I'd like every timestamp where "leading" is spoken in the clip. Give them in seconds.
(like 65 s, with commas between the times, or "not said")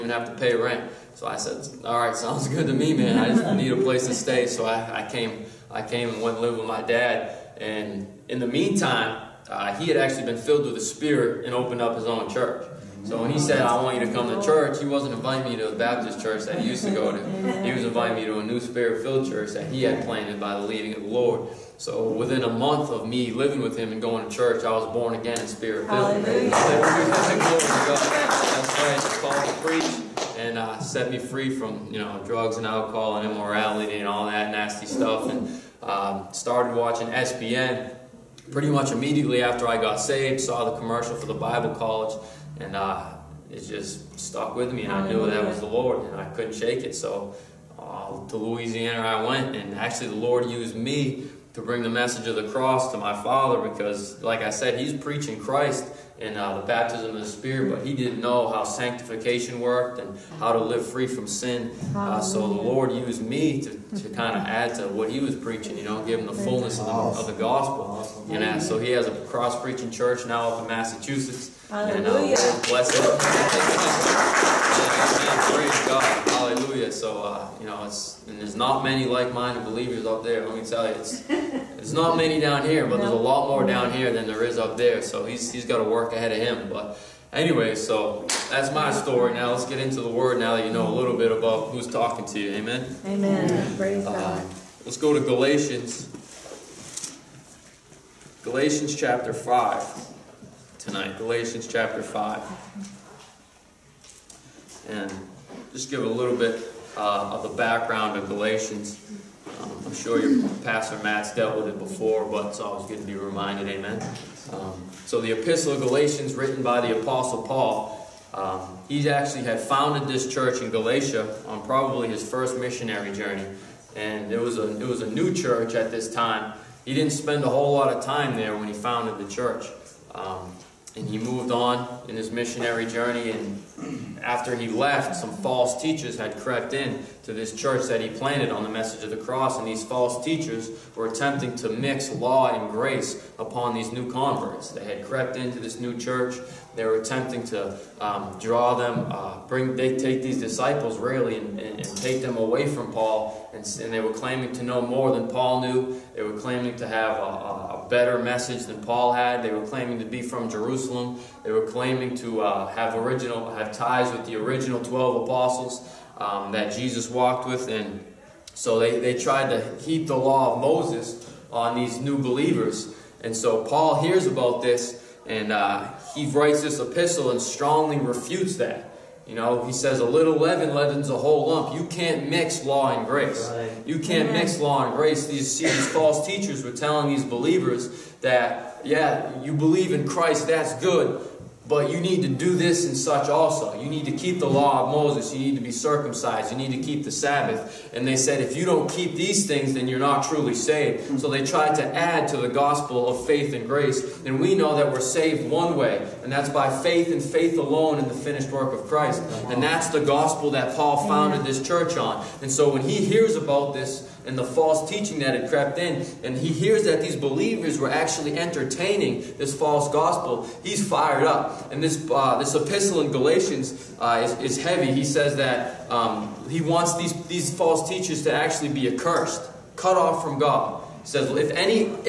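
20 s.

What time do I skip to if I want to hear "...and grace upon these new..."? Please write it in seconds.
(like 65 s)
142 s.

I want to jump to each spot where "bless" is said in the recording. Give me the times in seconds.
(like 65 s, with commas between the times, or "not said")
72 s.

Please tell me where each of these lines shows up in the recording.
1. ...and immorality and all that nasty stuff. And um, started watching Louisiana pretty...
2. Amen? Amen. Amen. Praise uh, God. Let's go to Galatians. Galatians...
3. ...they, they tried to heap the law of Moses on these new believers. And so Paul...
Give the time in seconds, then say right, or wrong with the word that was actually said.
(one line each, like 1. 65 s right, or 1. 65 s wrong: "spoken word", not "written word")
1. 33 s wrong: "SBN", not "Louisiana"
2. 92 s right
3. 168 s right.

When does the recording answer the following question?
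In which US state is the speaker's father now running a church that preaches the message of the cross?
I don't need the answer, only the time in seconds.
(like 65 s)
70 s.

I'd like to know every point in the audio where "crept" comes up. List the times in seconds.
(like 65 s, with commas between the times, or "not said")
136 s, 145 s, 215 s.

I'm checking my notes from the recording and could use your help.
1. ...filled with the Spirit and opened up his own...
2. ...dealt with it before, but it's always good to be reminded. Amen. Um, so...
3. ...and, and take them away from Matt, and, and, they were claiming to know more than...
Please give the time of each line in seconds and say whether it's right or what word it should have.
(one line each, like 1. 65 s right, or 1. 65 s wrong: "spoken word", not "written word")
1. 10 s right
2. 111 s right
3. 151 s wrong: "Paul", not "Matt".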